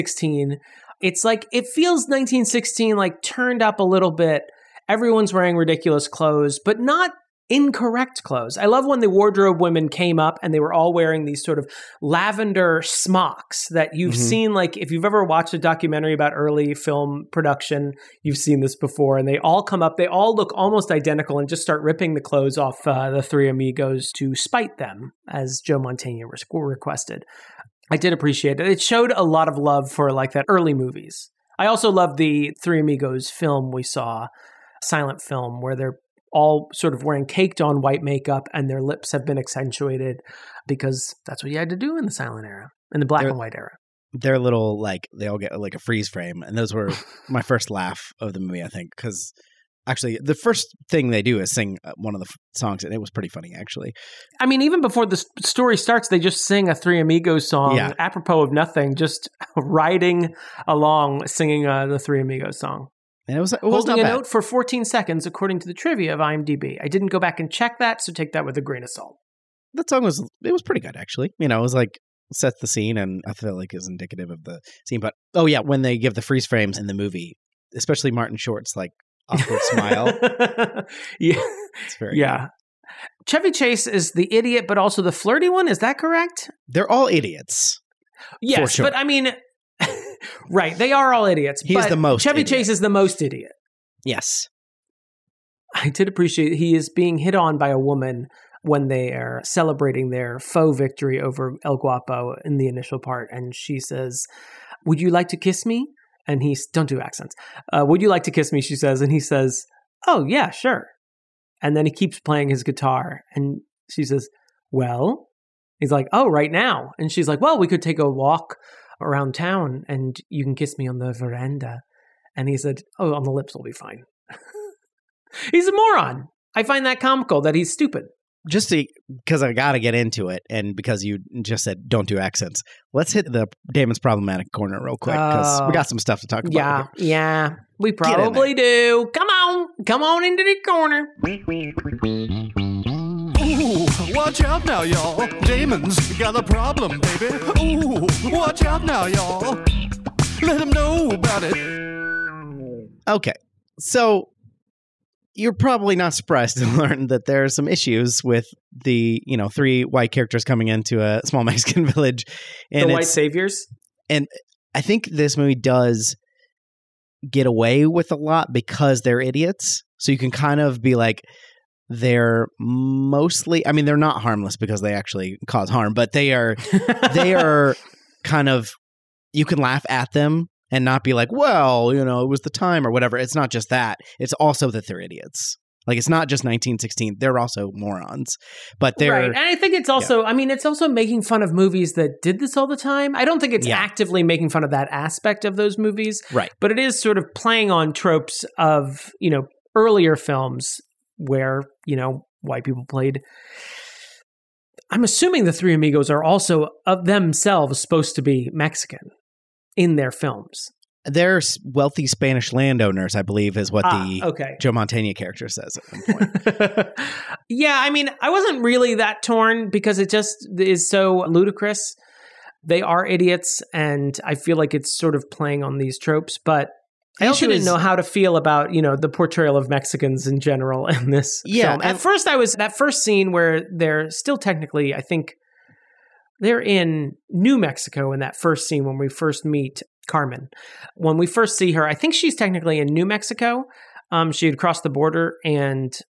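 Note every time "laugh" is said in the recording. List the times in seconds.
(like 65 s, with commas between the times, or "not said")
47 s, 179 s.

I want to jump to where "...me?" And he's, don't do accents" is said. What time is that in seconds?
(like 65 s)
105 s.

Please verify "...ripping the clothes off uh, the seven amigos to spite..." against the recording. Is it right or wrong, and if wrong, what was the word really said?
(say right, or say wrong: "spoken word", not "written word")
wrong: "three", not "seven".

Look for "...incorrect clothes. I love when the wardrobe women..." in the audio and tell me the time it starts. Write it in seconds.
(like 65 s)
7 s.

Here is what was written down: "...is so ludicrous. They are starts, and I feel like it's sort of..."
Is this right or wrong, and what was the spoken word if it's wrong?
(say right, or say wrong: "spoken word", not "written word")
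wrong: "idiots", not "starts".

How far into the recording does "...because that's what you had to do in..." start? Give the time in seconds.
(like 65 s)
40 s.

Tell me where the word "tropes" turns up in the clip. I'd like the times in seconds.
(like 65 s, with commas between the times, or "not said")
197 s, 225 s.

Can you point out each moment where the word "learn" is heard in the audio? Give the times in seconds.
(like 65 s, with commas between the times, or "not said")
156 s.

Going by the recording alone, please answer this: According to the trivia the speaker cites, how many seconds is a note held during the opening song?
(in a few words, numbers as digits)
14.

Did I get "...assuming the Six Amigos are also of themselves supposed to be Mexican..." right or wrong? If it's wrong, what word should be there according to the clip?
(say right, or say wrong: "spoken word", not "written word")
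wrong: "Three", not "Six".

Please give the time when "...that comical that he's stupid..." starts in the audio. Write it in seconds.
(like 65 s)
126 s.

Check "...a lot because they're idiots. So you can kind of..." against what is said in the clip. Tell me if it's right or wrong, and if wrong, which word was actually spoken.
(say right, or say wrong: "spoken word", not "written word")
right.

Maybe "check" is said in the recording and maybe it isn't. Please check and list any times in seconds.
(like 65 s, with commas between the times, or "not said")
67 s.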